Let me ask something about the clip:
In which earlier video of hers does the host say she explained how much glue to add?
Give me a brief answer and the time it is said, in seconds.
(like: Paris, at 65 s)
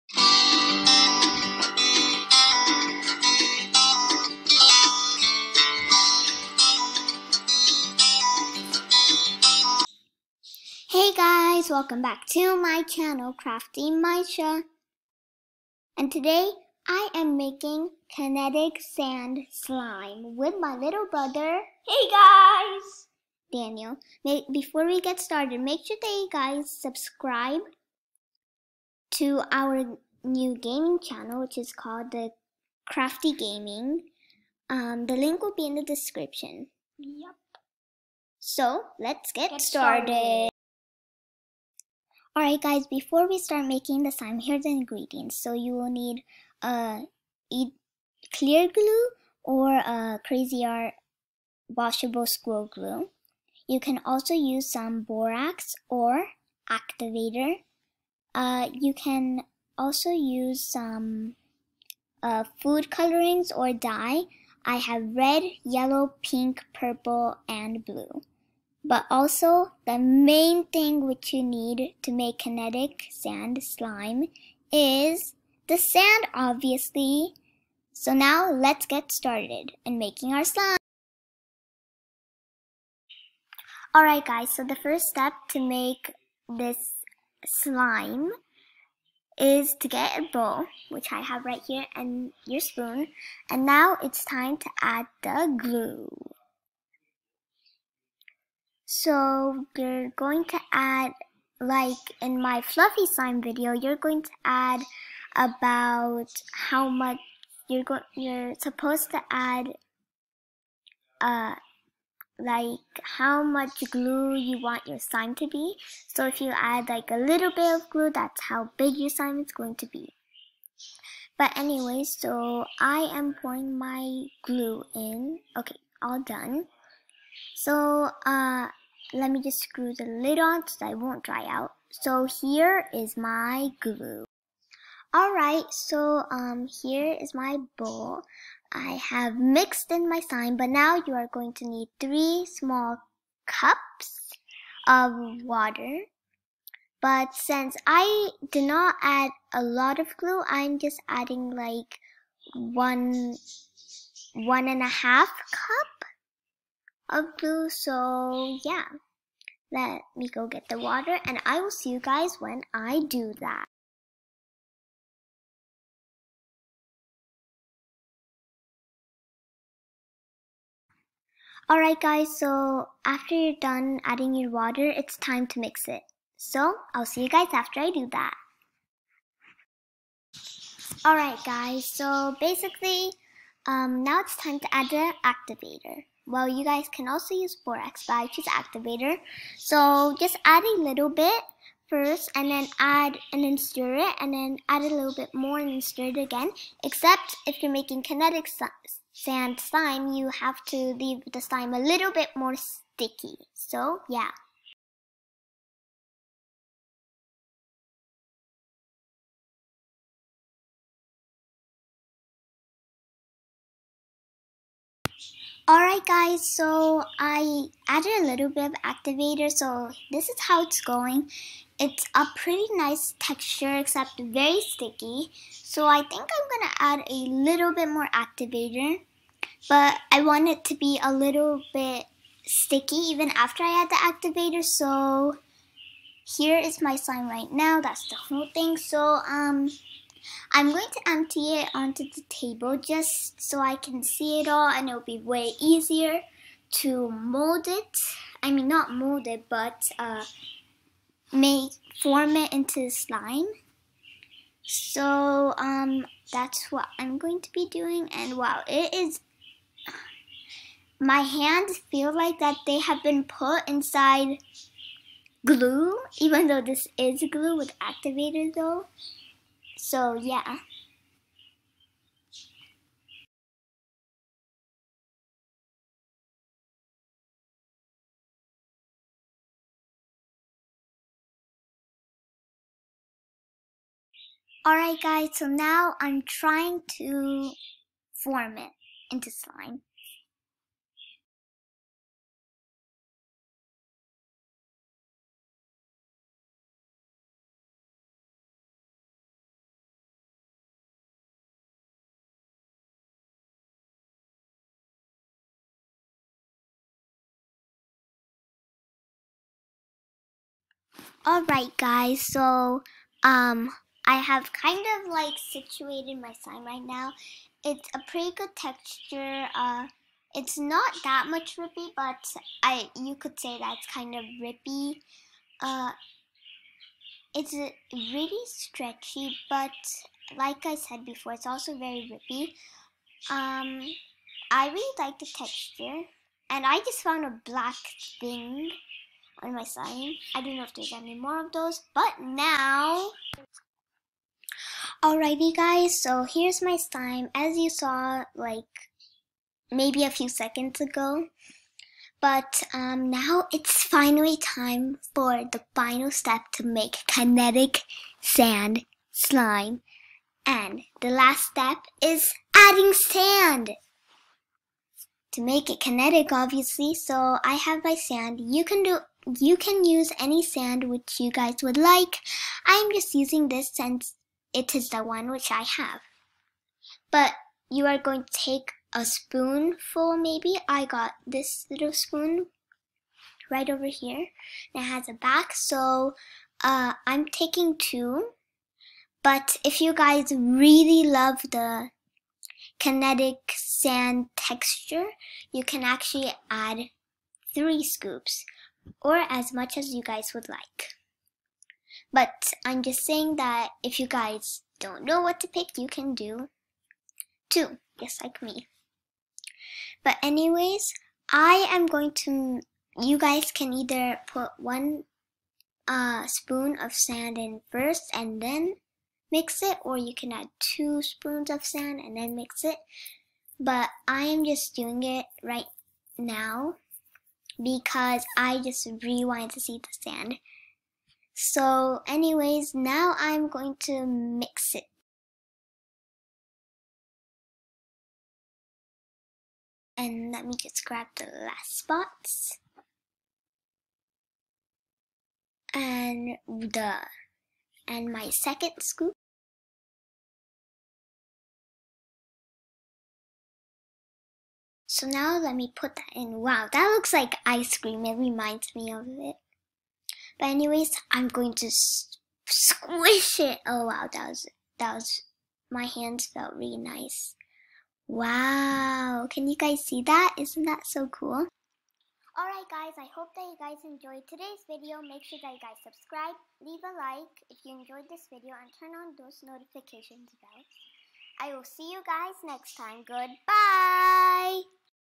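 fluffy slime video, at 102 s.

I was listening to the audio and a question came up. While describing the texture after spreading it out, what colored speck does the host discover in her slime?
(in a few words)
black.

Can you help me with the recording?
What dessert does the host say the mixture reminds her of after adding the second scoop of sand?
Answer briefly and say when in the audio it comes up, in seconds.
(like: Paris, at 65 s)
ice cream, at 457 s.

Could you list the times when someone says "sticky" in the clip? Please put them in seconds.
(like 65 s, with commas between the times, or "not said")
202 s, 224 s, 232 s.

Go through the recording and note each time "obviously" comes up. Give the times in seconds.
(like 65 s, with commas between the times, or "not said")
76 s, 366 s.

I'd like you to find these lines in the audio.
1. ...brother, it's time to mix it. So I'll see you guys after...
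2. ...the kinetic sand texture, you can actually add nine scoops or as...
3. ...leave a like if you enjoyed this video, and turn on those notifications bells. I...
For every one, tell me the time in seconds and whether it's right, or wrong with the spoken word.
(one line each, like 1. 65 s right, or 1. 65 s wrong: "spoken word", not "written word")
1. 174 s wrong: "water", not "brother"
2. 391 s wrong: "three", not "nine"
3. 476 s right.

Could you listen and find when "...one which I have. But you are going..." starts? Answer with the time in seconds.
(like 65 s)
375 s.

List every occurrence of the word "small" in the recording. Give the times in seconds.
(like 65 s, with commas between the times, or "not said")
142 s.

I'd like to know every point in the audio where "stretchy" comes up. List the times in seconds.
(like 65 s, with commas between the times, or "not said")
328 s.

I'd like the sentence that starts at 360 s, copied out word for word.
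And the last step is adding sand.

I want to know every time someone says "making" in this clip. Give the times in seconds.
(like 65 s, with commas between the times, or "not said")
17 s, 43 s, 79 s, 197 s.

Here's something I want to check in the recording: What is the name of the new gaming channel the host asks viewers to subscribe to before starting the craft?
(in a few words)
Crafty Gaming.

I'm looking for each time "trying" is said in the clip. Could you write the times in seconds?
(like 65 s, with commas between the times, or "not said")
286 s.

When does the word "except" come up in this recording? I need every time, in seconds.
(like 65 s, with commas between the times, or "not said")
196 s, 223 s.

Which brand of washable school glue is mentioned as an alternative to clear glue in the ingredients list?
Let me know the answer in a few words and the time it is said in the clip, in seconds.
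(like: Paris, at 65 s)
Cra-Z-Art, at 50 s.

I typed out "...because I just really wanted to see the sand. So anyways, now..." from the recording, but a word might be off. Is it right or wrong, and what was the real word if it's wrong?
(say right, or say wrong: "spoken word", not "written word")
right.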